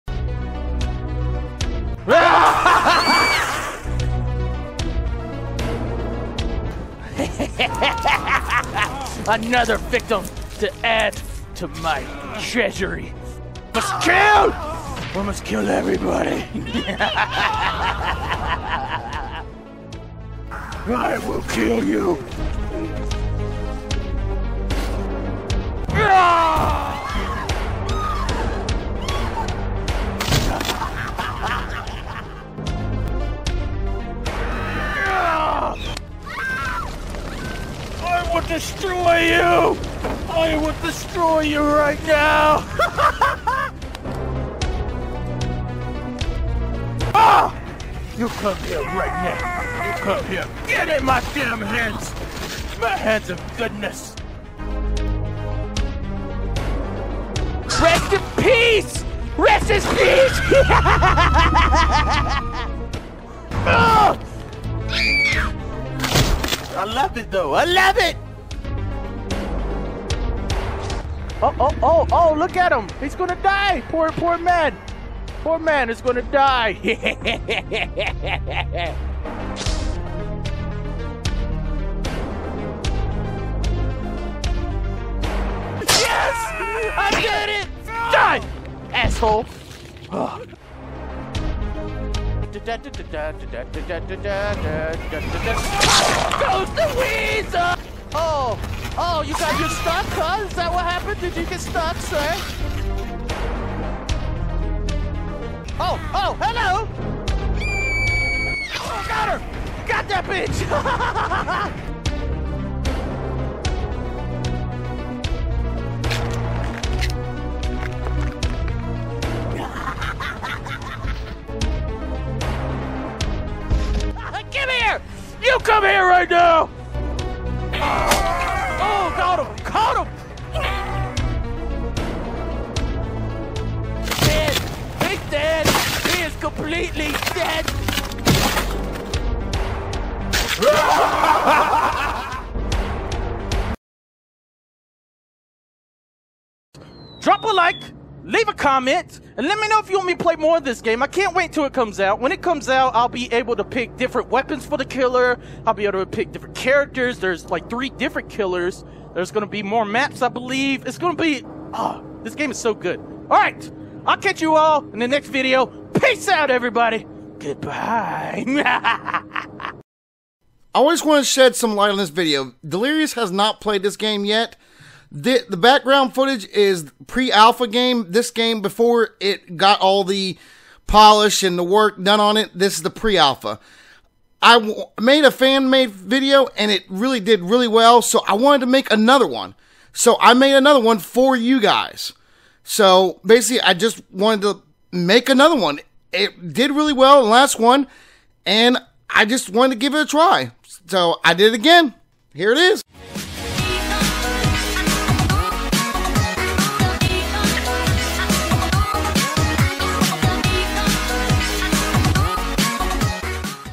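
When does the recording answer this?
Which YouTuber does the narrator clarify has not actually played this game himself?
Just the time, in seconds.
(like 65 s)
172 s.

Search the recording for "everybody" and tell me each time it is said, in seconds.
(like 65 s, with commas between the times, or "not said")
15 s, 166 s.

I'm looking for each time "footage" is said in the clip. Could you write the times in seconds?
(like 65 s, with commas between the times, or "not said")
176 s.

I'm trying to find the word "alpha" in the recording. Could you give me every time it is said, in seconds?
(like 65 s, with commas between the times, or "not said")
177 s, 183 s.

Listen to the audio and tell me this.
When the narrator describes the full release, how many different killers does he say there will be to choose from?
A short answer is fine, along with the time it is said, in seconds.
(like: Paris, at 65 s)
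3, at 157 s.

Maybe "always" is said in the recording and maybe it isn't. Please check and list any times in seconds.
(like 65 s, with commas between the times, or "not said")
170 s.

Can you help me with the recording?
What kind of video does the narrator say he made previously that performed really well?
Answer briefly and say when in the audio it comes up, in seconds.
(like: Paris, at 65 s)
Fan made video, at 185 s.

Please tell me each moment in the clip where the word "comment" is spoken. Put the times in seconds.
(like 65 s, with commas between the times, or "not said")
148 s.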